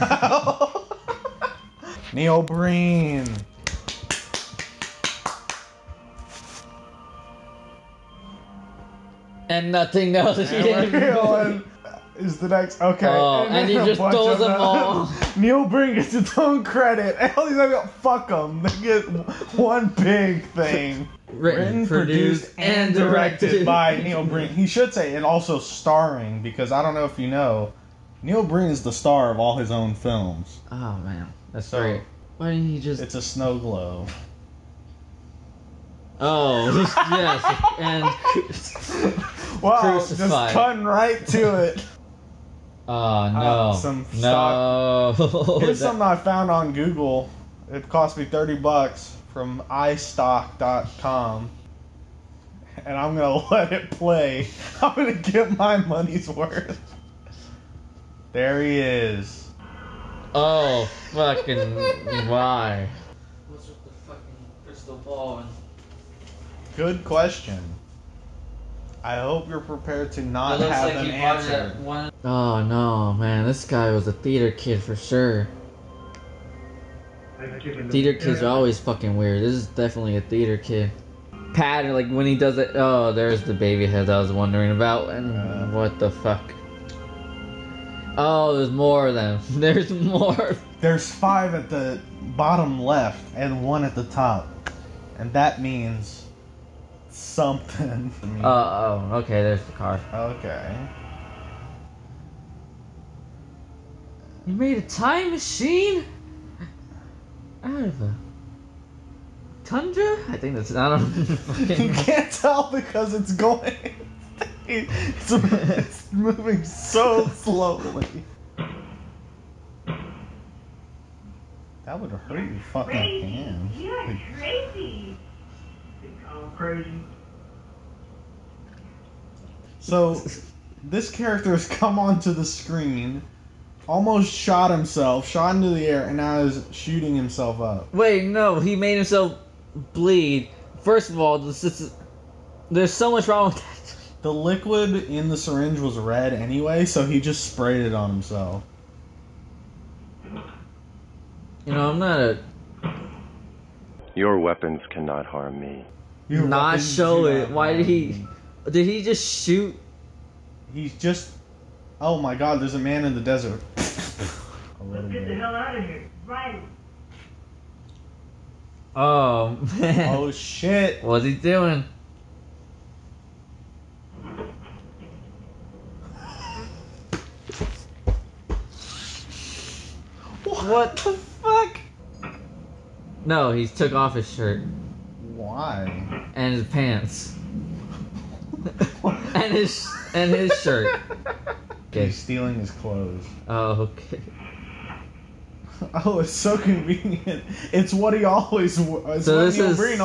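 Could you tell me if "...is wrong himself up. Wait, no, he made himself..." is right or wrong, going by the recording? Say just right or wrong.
wrong.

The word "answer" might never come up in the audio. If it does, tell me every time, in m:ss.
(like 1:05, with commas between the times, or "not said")
1:11.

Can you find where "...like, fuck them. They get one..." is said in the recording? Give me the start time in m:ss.
0:17.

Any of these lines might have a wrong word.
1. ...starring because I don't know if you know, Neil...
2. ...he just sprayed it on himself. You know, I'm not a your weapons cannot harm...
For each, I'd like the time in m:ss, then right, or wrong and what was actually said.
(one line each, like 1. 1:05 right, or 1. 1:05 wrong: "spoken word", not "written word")
1. 0:25 right
2. 2:27 right.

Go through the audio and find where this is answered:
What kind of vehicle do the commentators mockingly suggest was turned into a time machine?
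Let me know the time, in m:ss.
1:48.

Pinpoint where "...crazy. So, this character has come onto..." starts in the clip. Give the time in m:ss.
2:06.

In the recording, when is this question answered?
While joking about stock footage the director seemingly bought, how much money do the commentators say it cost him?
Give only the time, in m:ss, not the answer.
0:48.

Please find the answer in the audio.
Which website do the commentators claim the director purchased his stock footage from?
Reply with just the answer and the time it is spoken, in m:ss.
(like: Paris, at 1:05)
iStock.com, at 0:49.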